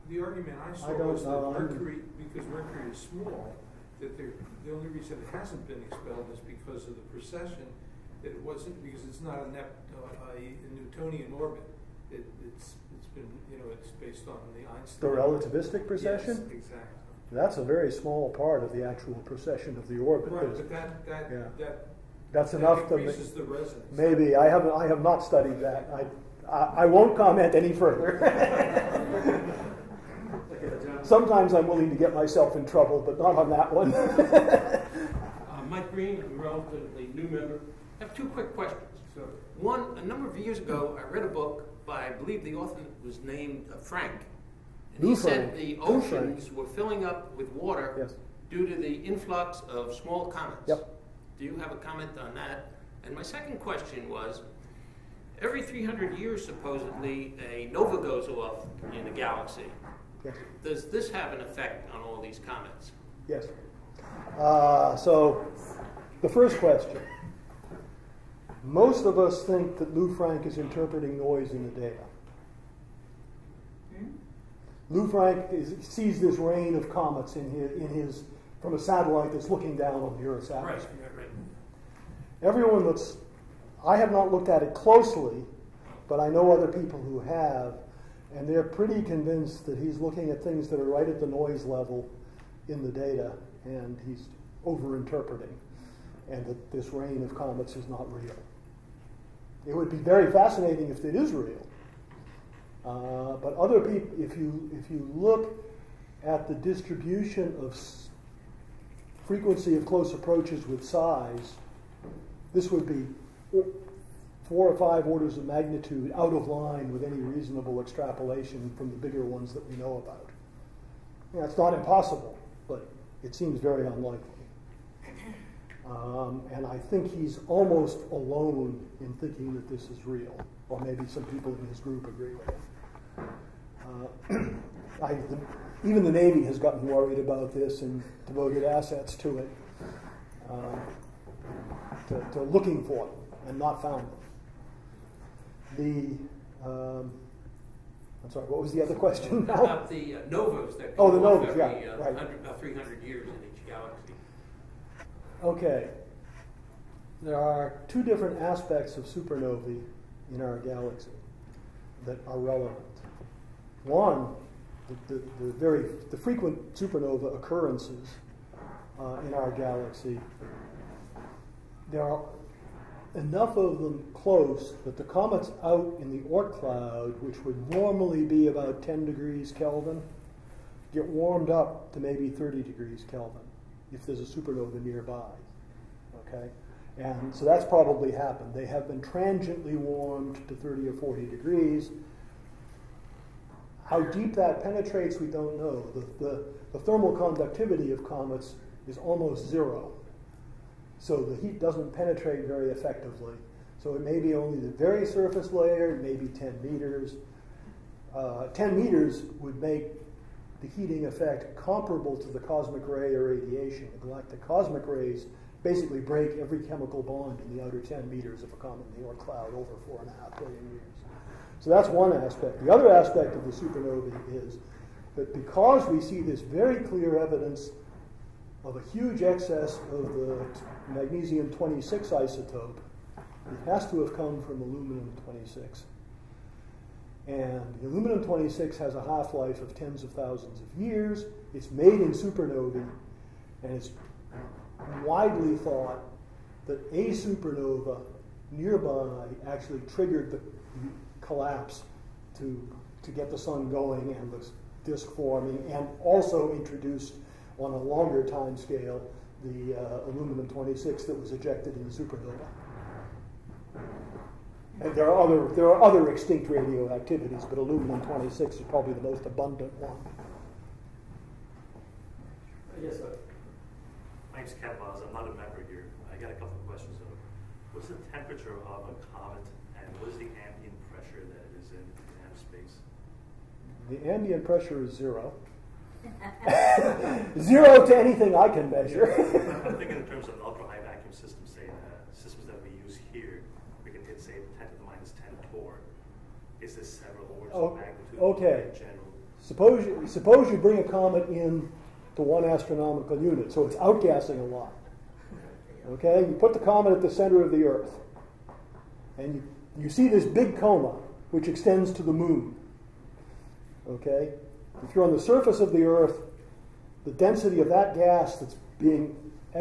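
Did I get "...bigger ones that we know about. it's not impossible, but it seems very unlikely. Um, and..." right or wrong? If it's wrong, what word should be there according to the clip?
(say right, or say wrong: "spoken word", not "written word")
right.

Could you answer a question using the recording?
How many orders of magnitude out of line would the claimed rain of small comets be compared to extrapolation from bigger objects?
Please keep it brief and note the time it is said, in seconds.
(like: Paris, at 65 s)
4 or 5, at 114 s.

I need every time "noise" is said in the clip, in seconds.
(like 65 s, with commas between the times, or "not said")
71 s, 91 s.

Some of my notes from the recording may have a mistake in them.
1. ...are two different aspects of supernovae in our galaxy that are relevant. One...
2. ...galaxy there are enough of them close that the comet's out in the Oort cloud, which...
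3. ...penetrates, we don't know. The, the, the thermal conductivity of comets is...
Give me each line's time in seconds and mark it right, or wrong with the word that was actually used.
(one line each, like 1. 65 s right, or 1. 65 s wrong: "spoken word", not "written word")
1. 157 s right
2. 169 s right
3. 194 s right.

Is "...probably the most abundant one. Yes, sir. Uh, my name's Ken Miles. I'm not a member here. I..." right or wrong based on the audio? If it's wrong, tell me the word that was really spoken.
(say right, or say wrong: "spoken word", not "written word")
right.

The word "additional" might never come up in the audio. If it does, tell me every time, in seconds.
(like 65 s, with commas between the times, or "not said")
not said.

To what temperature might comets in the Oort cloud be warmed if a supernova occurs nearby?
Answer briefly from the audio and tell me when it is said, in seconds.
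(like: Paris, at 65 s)
30 degrees Kelvin, at 182 s.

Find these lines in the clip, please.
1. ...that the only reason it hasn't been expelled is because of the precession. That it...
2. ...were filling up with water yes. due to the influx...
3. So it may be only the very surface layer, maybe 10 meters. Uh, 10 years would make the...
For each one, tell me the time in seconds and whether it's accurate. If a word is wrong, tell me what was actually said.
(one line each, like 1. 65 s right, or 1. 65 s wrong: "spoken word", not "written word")
1. 3 s right
2. 46 s right
3. 203 s wrong: "meters", not "years".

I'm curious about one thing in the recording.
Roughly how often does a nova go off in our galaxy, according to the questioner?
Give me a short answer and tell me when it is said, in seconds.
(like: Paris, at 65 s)
every 300 years, at 55 s.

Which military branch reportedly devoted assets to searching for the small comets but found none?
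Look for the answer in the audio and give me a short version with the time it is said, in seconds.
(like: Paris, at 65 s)
the Navy, at 136 s.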